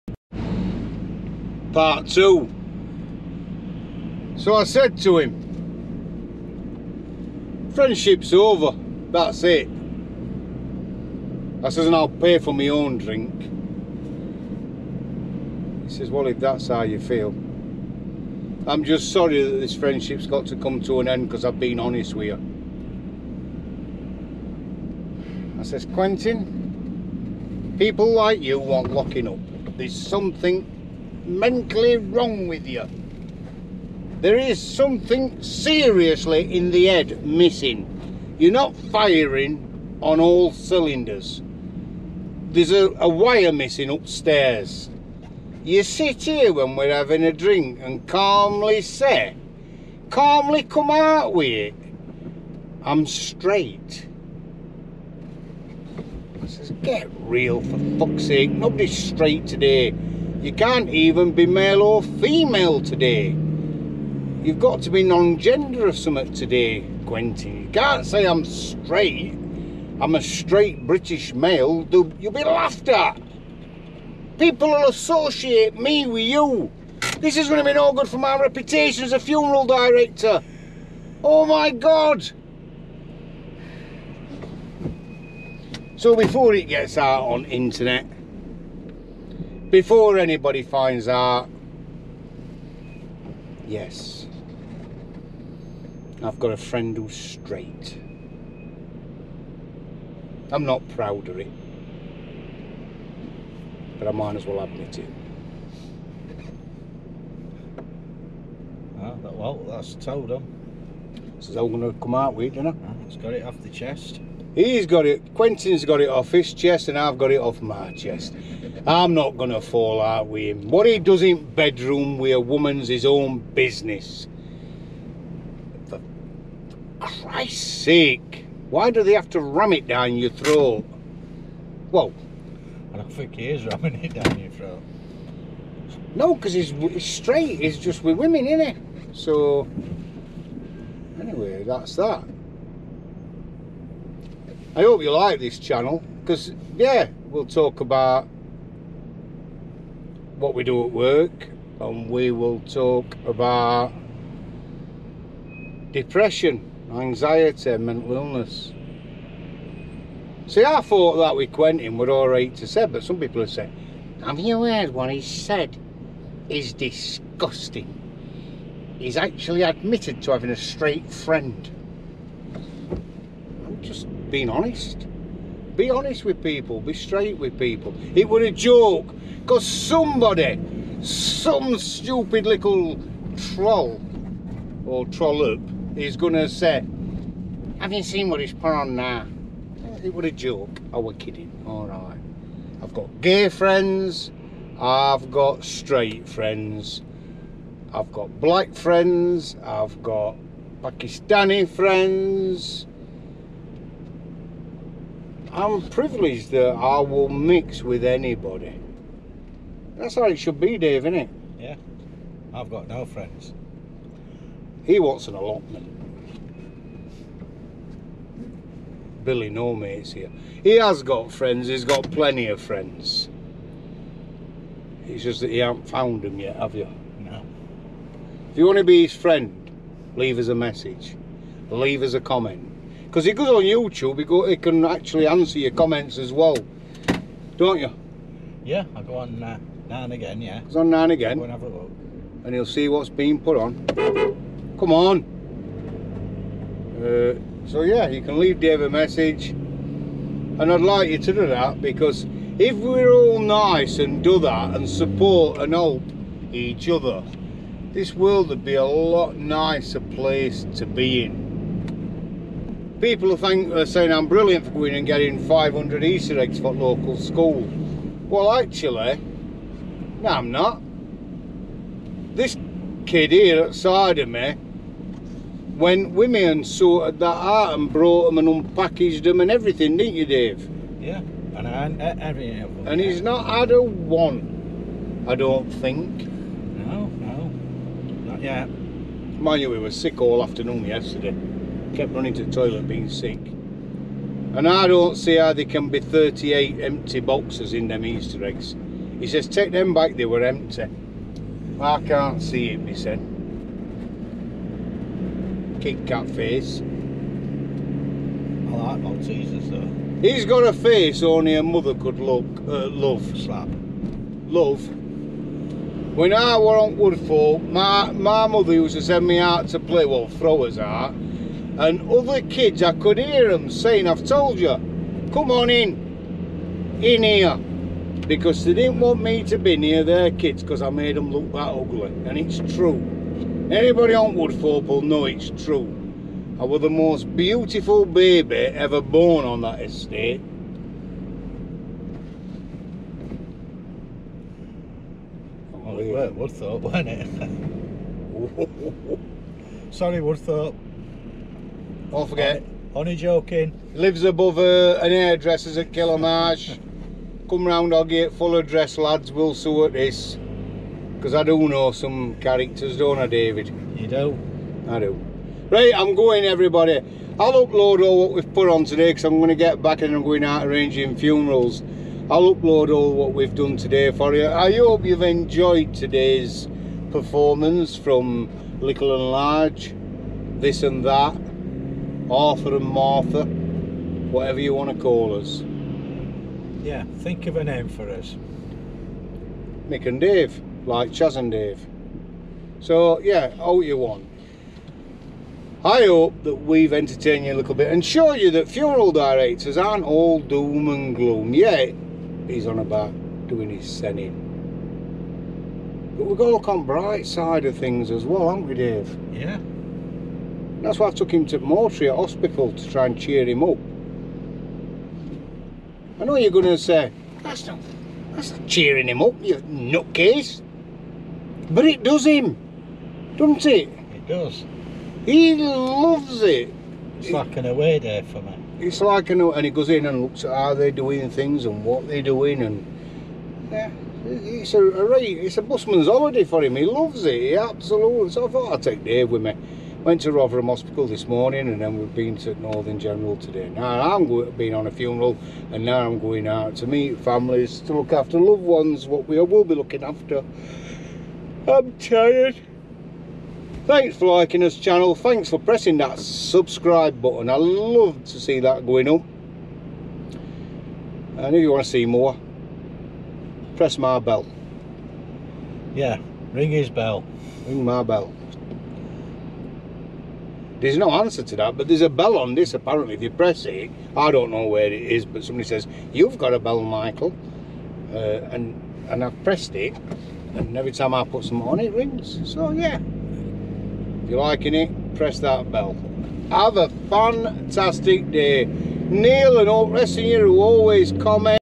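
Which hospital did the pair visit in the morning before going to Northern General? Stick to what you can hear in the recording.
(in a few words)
Rotherham Hospital.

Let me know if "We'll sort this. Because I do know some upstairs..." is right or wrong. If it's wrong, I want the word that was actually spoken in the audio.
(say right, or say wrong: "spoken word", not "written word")
wrong: "characters", not "upstairs".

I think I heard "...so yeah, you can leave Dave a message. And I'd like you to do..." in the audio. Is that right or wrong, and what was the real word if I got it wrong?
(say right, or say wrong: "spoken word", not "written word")
right.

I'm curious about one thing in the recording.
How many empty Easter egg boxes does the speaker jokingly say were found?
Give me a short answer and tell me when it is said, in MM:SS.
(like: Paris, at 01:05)
38, at 04:55.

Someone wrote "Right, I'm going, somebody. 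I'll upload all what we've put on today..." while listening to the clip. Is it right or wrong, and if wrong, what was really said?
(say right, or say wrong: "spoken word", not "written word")
wrong: "everybody", not "somebody".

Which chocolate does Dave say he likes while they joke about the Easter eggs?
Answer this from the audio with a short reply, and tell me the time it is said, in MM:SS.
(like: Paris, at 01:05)
Maltesers, at 05:09.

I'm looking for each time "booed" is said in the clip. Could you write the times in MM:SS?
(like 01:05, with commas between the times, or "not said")
not said.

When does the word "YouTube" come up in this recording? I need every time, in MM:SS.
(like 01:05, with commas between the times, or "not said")
03:53.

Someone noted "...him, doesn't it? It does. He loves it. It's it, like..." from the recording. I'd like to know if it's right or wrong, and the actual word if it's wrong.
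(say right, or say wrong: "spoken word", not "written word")
right.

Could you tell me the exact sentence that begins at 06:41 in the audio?
Yet he's on about doing his sending.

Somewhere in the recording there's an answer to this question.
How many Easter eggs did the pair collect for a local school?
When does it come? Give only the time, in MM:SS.
04:25.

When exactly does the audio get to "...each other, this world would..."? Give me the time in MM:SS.
04:16.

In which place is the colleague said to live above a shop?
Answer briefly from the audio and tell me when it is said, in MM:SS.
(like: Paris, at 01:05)
Killamarsh, at 05:55.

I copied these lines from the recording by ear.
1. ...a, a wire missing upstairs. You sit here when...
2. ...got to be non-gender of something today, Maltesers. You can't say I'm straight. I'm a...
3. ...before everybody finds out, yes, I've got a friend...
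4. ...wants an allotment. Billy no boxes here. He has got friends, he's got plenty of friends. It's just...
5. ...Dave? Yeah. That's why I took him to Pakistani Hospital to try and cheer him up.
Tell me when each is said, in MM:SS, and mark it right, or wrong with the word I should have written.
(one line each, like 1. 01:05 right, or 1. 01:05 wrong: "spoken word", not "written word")
1. 00:42 right
2. 01:04 wrong: "Quentin", not "Maltesers"
3. 01:29 wrong: "anybody", not "everybody"
4. 03:34 wrong: "mates", not "boxes"
5. 06:48 wrong: "Mortria", not "Pakistani".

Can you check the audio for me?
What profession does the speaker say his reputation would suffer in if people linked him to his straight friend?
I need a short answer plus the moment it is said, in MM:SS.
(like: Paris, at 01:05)
Funeral director, at 01:19.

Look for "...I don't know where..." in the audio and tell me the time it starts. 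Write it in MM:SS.
07:54.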